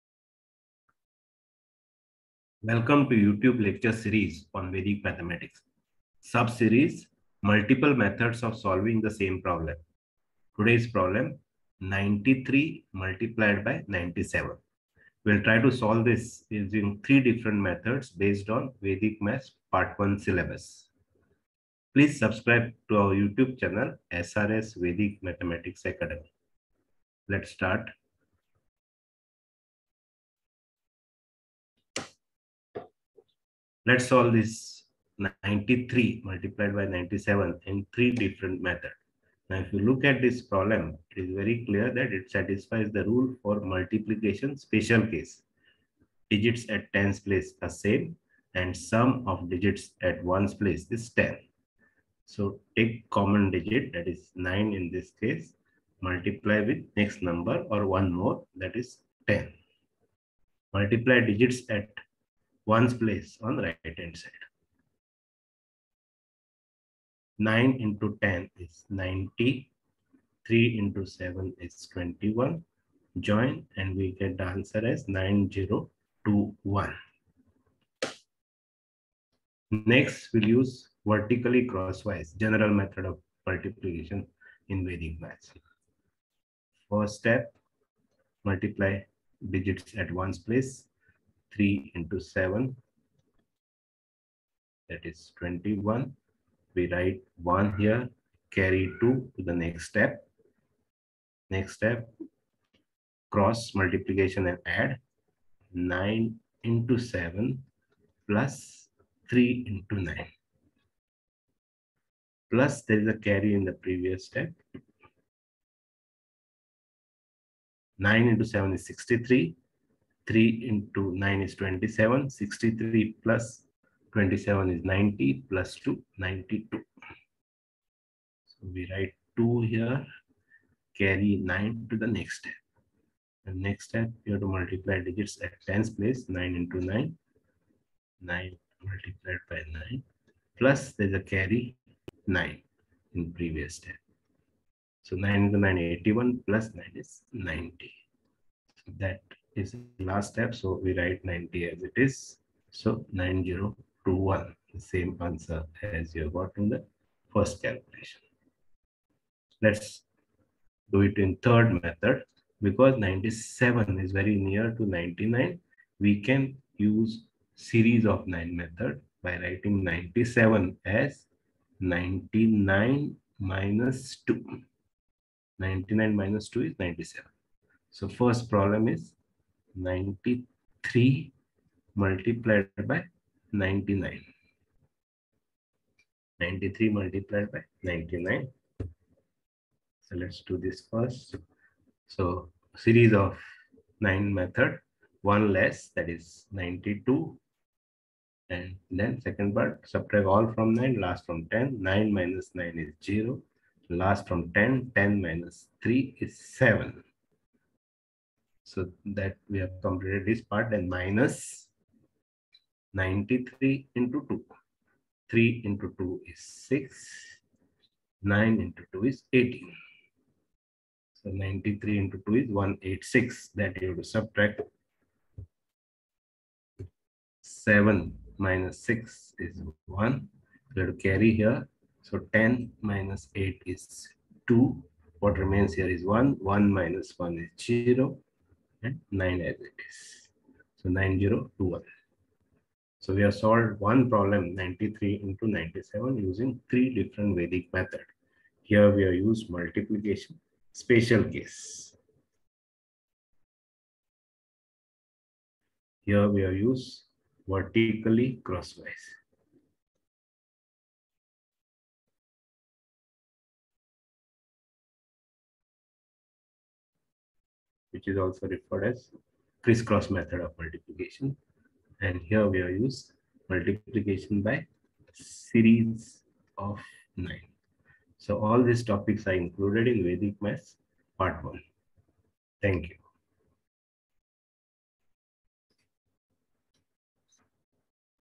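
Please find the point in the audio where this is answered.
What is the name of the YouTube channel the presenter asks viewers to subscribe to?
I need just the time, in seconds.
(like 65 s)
24 s.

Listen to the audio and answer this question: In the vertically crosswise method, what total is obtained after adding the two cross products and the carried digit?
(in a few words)
92.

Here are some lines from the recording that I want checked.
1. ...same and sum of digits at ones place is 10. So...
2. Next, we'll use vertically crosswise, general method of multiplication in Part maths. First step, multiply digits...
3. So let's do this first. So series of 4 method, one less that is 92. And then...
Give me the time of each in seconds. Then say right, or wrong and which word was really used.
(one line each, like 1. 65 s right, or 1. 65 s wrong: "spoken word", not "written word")
1. 47 s right
2. 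79 s wrong: "Vedic", not "Part"
3. 188 s wrong: "9", not "4".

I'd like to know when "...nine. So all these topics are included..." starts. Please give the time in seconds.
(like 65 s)
277 s.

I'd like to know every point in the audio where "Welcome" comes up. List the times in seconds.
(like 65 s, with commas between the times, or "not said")
2 s.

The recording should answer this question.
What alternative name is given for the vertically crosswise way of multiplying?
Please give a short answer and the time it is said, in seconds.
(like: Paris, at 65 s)
crisscross method, at 269 s.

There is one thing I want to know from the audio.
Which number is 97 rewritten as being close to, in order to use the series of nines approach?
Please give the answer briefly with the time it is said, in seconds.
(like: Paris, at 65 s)
99, at 164 s.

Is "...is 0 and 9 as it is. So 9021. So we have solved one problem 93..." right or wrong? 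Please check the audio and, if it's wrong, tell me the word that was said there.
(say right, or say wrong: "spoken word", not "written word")
right.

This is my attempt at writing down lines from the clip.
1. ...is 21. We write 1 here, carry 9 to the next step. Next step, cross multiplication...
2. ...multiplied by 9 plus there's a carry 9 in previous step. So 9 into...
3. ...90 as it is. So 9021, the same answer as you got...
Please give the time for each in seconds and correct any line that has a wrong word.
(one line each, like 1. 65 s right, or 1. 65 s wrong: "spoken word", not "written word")
1. 95 s wrong: "2", not "9"
2. 138 s right
3. 151 s right.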